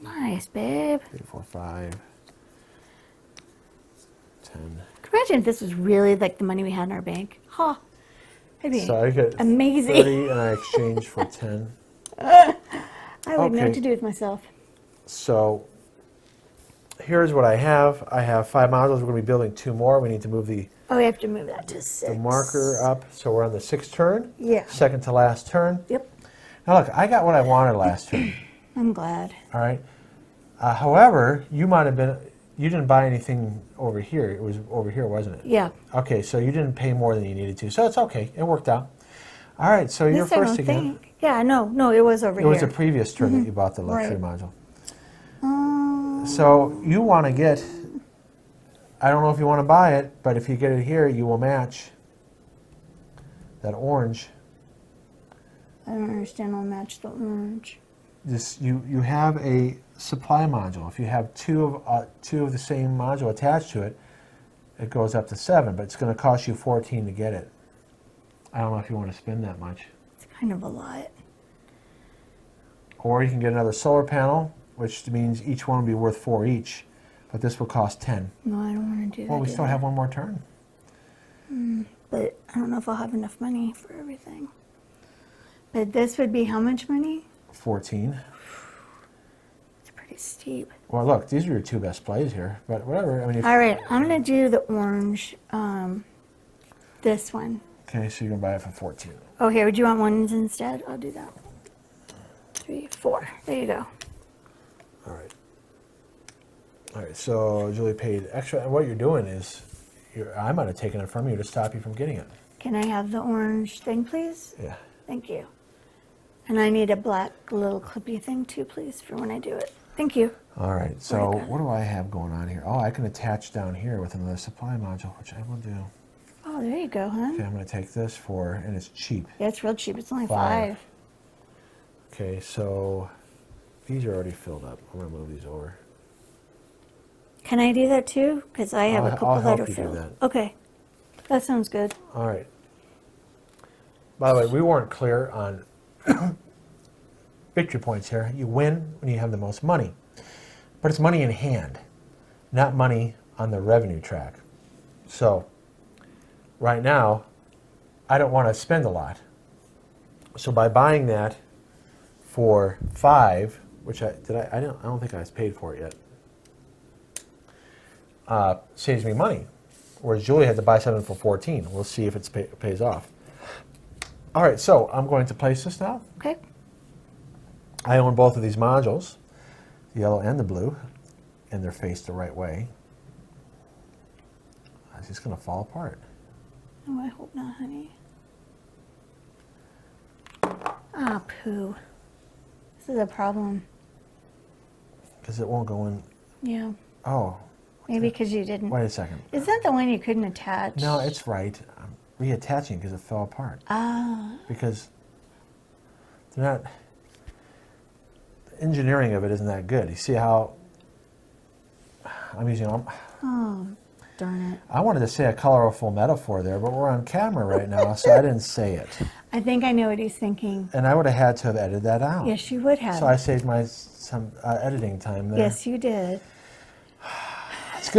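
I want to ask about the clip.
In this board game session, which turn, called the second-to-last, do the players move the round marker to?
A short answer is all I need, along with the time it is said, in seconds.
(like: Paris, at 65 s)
6th, at 23 s.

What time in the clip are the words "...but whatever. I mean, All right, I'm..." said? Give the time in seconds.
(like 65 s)
92 s.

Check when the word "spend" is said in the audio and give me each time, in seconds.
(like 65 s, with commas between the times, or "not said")
69 s, 158 s.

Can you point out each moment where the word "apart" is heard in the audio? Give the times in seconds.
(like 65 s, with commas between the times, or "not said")
185 s, 203 s.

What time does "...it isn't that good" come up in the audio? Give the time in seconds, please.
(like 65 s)
209 s.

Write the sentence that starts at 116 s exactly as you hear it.
And I need a black little clippy thing too, please, for when I do it.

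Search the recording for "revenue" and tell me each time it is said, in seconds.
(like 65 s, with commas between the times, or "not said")
153 s.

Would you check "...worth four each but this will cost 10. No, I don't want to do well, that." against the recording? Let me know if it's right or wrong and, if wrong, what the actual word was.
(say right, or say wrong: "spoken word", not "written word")
right.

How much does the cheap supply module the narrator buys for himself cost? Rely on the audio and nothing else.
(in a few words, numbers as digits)
5.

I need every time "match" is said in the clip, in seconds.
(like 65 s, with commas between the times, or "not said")
51 s, 56 s.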